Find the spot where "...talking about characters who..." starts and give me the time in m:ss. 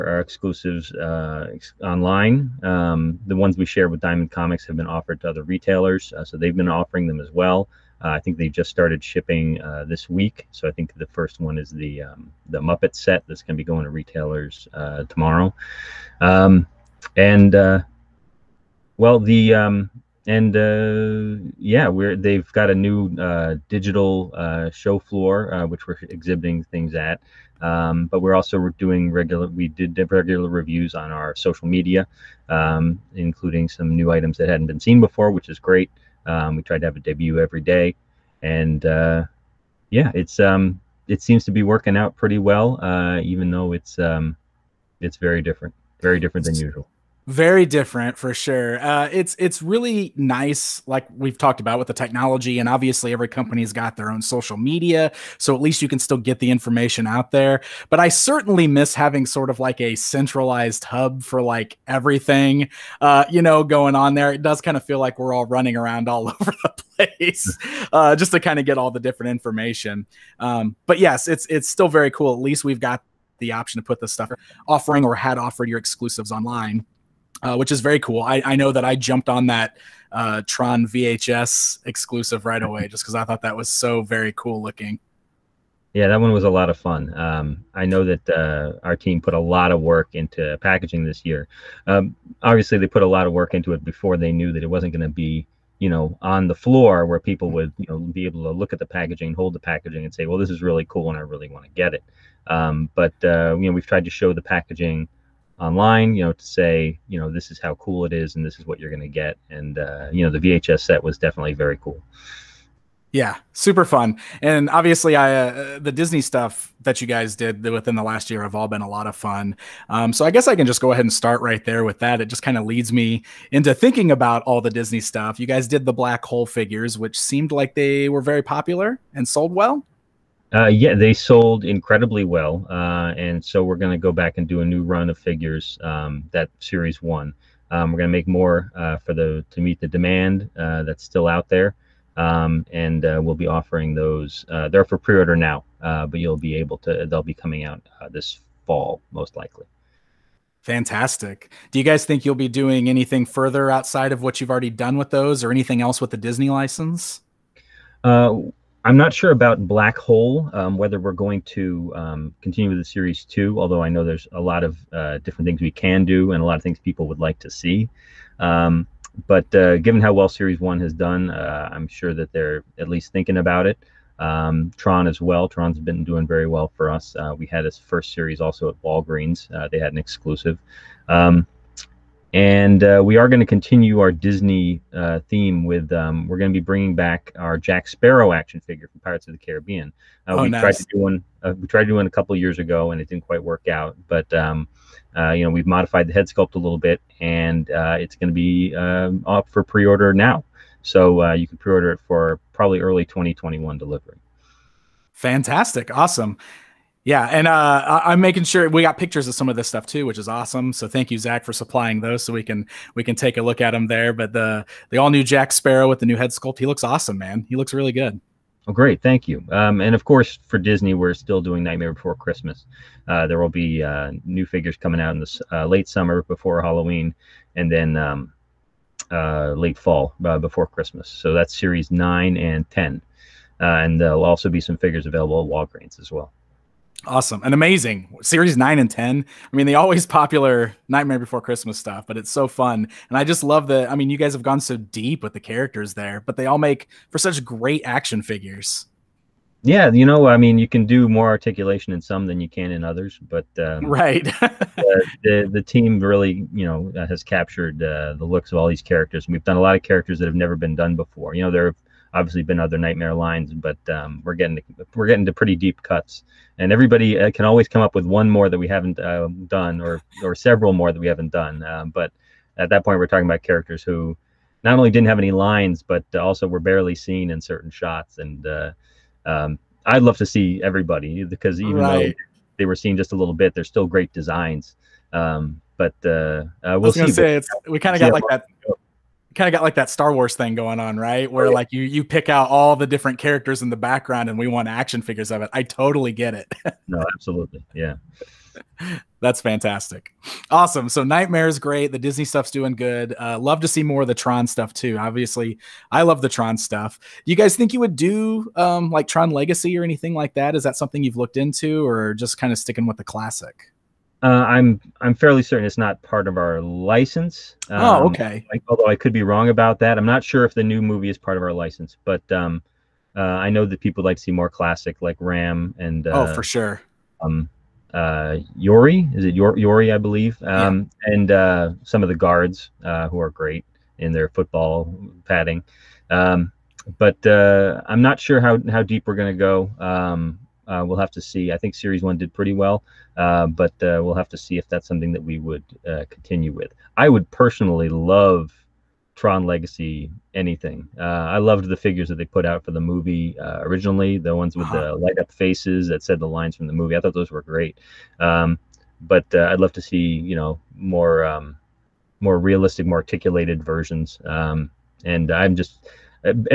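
4:33.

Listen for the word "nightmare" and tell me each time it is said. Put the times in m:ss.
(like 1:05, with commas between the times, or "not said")
3:41, 4:00, 4:22, 5:01.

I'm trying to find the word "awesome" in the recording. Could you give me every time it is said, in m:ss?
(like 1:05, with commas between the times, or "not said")
3:25, 3:30, 3:36, 3:57, 5:00.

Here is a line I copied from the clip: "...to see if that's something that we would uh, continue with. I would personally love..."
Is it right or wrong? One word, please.
right.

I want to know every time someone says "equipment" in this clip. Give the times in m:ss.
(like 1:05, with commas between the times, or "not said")
not said.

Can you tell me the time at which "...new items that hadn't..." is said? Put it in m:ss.
0:33.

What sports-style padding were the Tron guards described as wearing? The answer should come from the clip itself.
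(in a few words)
football padding.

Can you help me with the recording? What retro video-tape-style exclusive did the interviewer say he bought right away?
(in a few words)
Tron VHS.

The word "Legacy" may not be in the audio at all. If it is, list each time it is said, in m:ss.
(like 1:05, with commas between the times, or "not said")
5:09, 5:49.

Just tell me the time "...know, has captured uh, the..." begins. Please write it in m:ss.
4:16.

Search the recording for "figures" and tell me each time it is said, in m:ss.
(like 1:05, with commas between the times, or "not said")
2:06, 2:15, 3:08, 3:44, 3:54, 4:08, 4:55, 5:51.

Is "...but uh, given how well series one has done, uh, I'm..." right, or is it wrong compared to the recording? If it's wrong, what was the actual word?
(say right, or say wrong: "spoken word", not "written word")
right.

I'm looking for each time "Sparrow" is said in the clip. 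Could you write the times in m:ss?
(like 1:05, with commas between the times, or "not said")
3:07, 3:35.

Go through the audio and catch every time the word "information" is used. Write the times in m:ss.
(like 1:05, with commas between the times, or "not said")
0:56, 1:09.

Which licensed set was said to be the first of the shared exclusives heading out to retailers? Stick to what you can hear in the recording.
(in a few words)
Muppet set.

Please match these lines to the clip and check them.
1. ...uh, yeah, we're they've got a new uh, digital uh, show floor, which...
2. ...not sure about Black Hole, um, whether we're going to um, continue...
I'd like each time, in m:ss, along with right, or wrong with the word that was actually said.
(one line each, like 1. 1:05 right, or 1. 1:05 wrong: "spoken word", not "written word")
1. 0:20 right
2. 2:38 right.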